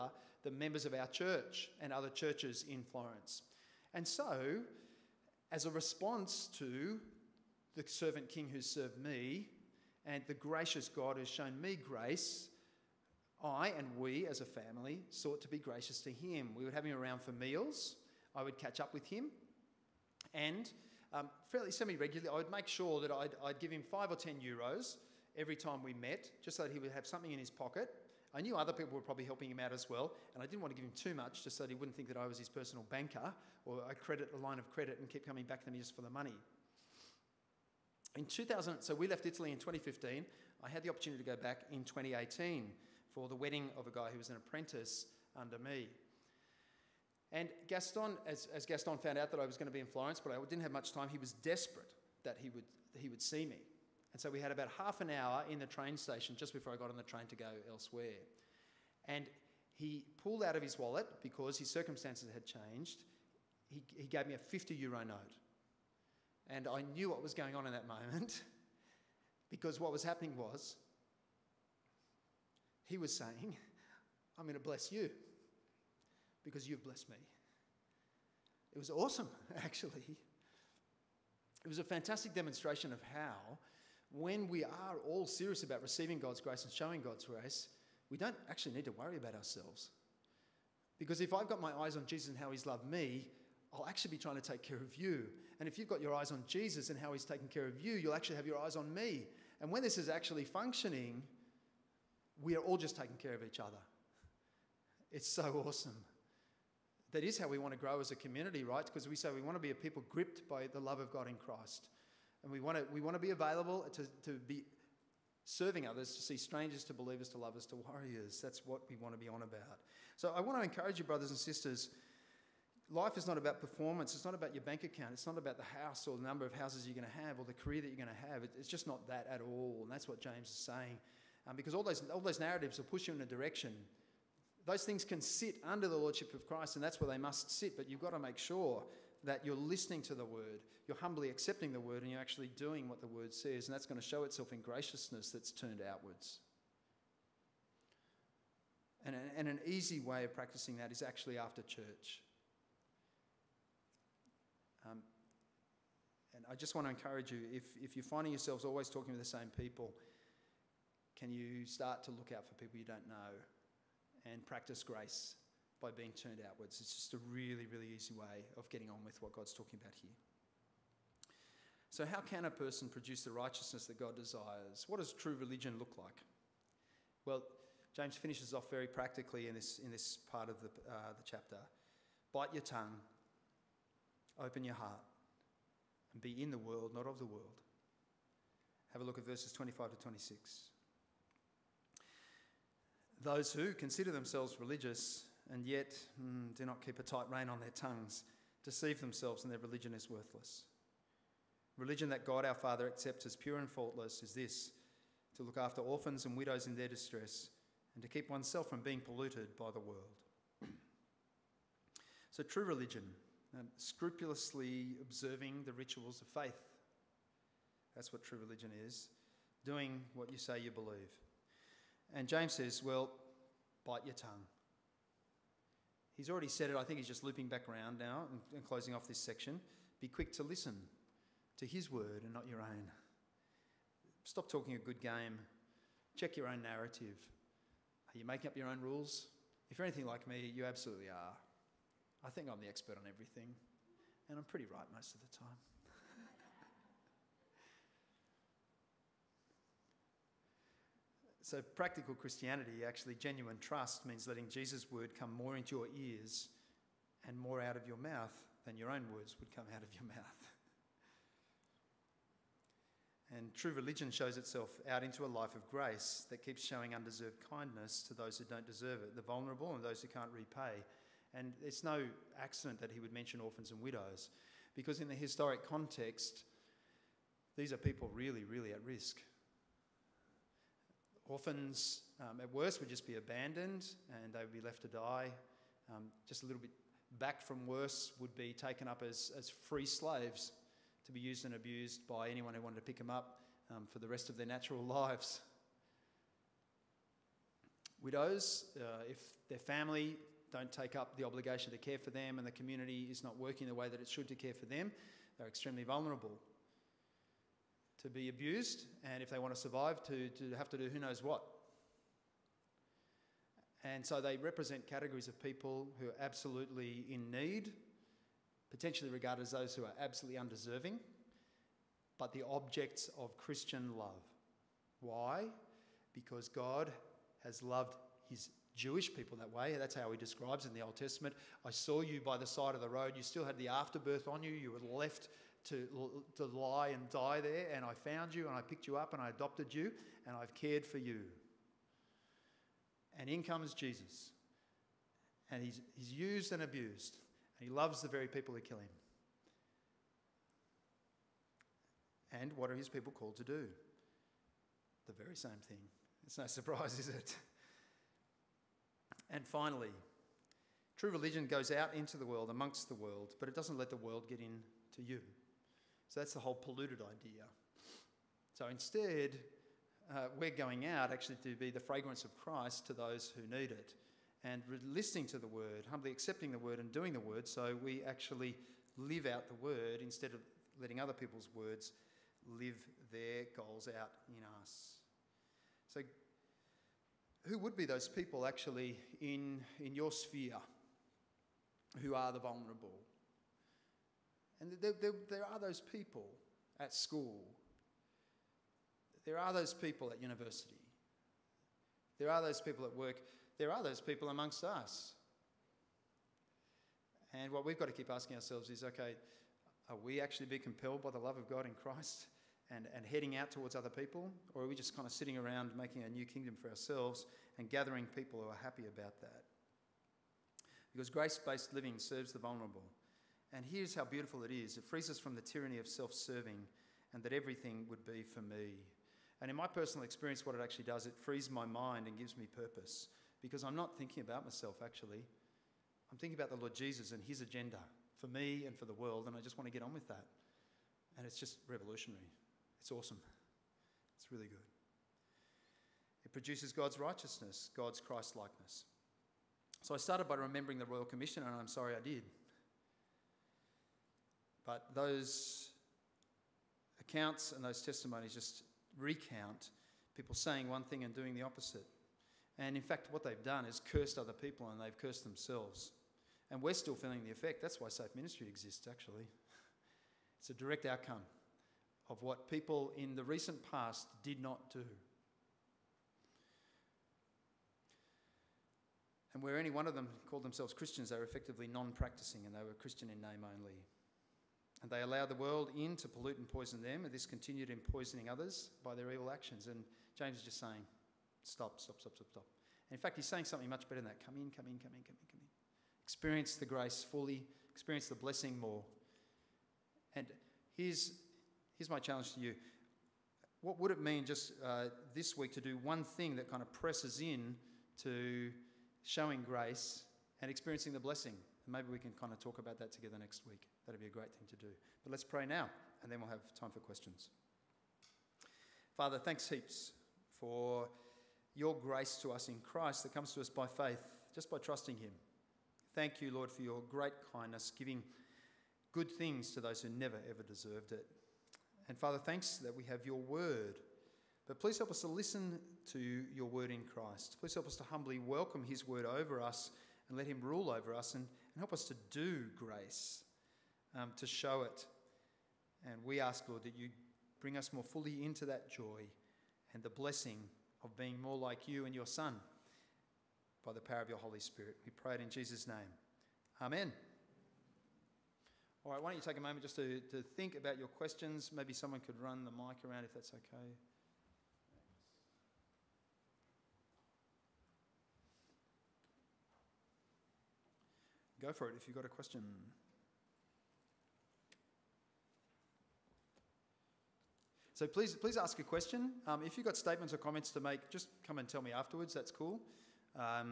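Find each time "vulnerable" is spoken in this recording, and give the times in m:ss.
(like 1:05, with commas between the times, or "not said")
4:29, 5:05, 6:32, 7:02.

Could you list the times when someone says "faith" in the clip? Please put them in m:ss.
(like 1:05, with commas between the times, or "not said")
3:36, 8:43.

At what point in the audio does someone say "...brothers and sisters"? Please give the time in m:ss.
2:01.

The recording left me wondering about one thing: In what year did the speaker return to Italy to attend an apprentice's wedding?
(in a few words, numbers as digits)
2018.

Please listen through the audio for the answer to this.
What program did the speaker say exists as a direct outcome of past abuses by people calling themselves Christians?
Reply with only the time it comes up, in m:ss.
7:47.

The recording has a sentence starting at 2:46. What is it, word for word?
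It's just a really, really easy way of getting on with what God's talking about here.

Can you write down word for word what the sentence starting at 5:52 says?
And what are his people called to do?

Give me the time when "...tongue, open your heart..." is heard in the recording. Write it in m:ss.
3:02.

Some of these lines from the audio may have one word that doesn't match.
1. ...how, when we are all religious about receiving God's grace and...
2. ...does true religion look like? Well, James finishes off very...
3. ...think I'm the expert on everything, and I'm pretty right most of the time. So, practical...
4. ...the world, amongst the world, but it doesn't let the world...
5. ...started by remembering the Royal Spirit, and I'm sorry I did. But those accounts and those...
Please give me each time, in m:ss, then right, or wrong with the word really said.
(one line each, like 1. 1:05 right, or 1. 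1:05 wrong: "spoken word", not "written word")
1. 1:23 wrong: "serious", not "religious"
2. 2:54 right
3. 4:02 right
4. 6:02 right
5. 7:29 wrong: "Commission", not "Spirit".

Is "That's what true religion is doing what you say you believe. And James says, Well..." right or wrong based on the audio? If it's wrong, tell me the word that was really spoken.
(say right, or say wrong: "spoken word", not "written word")
right.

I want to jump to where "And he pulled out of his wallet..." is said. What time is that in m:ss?
0:59.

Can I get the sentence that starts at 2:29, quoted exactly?
And, and an easy way of practicing that is actually after church.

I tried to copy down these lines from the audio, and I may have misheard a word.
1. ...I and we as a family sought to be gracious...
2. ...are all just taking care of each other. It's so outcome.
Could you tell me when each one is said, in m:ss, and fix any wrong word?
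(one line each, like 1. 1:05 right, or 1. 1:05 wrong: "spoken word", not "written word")
1. 0:13 right
2. 1:42 wrong: "awesome", not "outcome".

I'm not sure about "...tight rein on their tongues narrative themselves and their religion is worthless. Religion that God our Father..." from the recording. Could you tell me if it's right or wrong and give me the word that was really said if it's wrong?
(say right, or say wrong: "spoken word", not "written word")
wrong: "deceive", not "narrative".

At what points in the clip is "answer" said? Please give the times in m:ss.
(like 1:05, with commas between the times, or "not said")
not said.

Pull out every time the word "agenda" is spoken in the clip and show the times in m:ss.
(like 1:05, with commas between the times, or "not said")
7:17.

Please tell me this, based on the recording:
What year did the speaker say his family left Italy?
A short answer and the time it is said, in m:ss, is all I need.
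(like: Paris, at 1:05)
2015, at 0:39.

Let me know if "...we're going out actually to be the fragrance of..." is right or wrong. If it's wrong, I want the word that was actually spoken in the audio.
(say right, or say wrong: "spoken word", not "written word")
right.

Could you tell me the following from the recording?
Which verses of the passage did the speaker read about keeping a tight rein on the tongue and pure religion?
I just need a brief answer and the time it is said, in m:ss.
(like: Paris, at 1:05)
25 to 26, at 3:09.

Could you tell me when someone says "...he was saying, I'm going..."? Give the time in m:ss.
1:12.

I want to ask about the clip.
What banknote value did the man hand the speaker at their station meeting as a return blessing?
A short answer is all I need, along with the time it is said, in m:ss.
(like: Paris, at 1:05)
50 euros, at 1:04.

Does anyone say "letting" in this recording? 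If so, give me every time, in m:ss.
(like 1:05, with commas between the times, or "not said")
4:14, 6:20.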